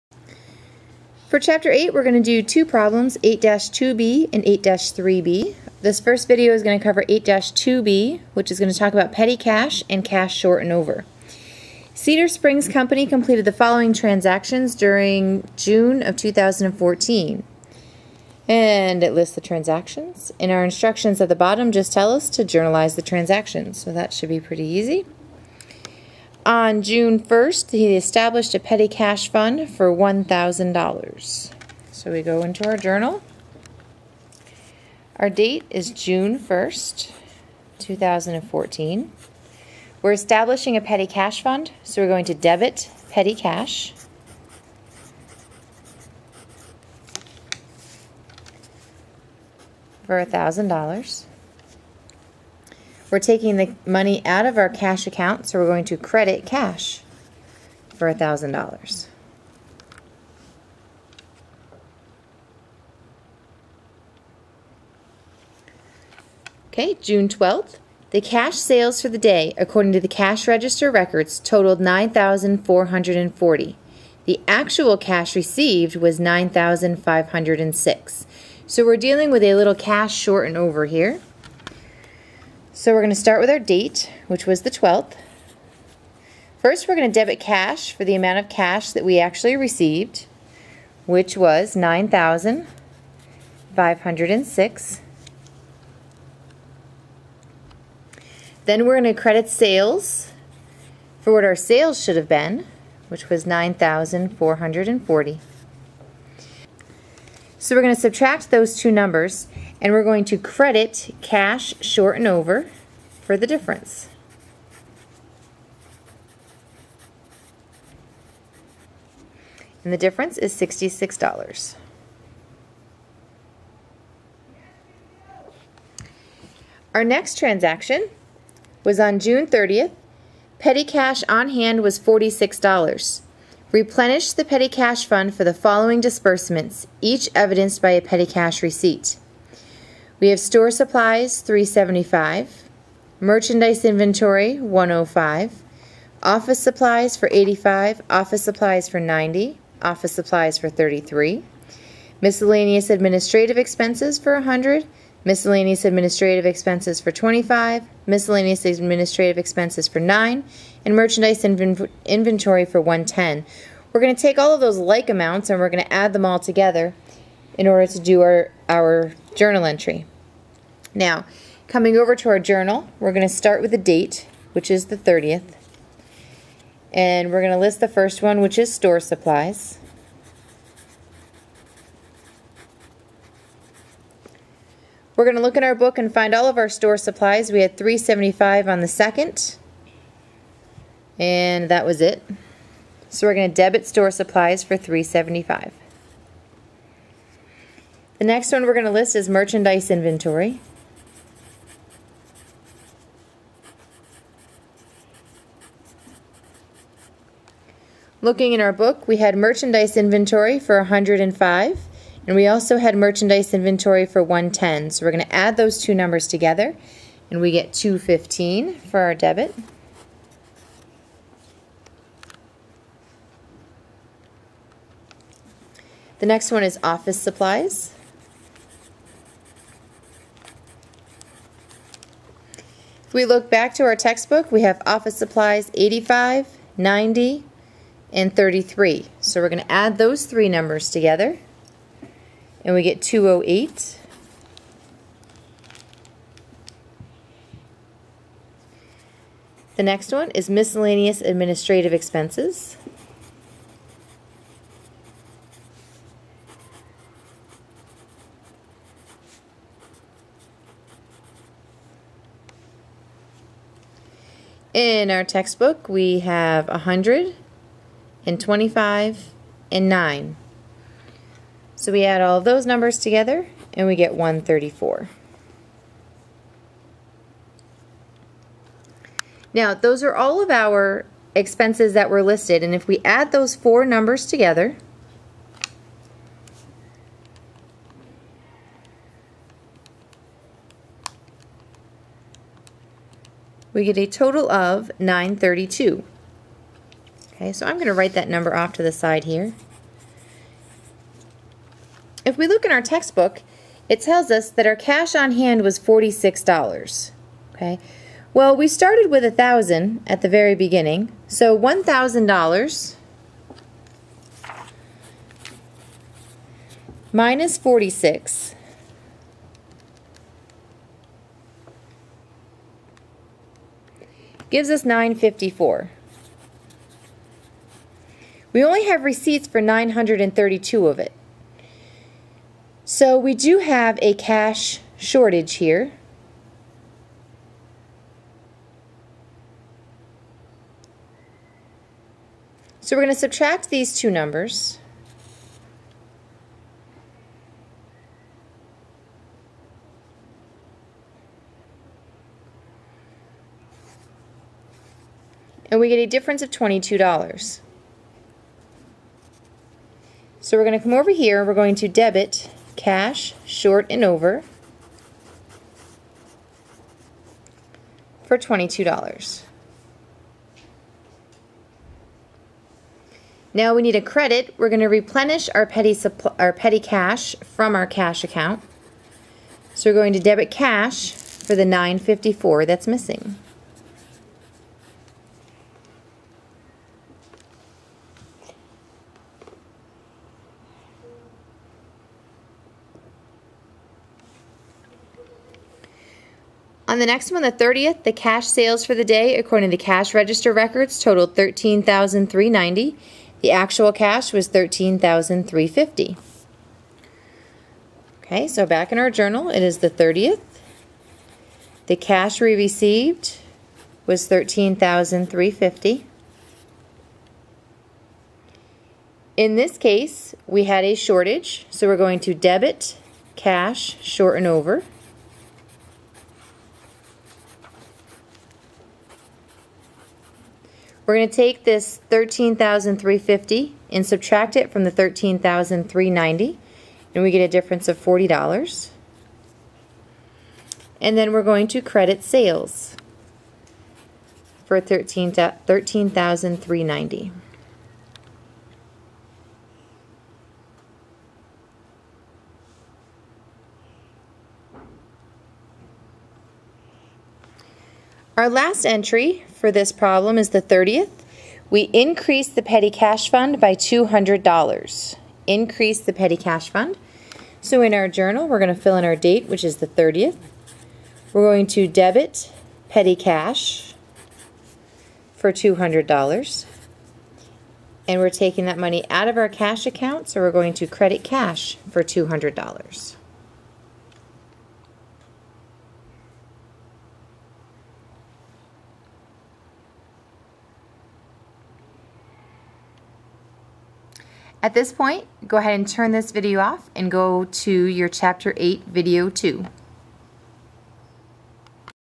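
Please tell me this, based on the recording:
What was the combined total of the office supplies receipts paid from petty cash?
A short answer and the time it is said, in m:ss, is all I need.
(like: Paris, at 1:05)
208, at 4:03.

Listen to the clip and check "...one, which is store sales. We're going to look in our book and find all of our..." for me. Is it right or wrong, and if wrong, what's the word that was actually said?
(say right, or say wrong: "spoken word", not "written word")
wrong: "supplies", not "sales".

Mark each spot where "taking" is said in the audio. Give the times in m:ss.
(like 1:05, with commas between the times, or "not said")
0:53, 7:58.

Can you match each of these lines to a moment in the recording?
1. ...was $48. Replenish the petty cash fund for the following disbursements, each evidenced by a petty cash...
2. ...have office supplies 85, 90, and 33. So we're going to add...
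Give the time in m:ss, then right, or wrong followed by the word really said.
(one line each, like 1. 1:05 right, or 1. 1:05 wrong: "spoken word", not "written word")
1. 2:11 wrong: "46", not "48"
2. 3:54 right.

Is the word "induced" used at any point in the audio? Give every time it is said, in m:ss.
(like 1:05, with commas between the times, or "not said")
not said.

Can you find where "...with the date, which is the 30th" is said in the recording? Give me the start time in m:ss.
2:53.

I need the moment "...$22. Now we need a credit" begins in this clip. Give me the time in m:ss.
6:08.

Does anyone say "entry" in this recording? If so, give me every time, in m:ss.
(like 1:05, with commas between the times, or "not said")
2:49, 7:38.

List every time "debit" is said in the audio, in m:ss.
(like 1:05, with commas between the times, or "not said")
0:42, 1:27, 3:13, 3:39, 6:01, 6:20, 7:02, 7:51.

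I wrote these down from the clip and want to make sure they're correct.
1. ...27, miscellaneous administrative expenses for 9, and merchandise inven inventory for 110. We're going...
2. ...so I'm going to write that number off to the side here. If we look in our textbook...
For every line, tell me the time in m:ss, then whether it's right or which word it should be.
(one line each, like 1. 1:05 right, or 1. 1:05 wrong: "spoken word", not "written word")
1. 2:37 wrong: "25", not "27"
2. 4:57 right.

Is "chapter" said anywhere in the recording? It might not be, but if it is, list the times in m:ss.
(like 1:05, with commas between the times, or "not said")
0:01, 8:18.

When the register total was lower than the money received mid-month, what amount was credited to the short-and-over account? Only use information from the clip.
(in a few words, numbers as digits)
$66.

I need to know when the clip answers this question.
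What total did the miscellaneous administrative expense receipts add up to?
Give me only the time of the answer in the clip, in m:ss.
4:34.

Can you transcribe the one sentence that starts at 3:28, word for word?
Looking in our book, we had merchandise inventory for 105, and we also had merchandise inventory for 110.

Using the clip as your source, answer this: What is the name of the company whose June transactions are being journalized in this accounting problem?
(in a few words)
Cedar Springs Company.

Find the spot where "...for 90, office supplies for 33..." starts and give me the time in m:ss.
2:28.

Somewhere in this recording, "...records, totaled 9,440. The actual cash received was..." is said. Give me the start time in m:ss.
1:10.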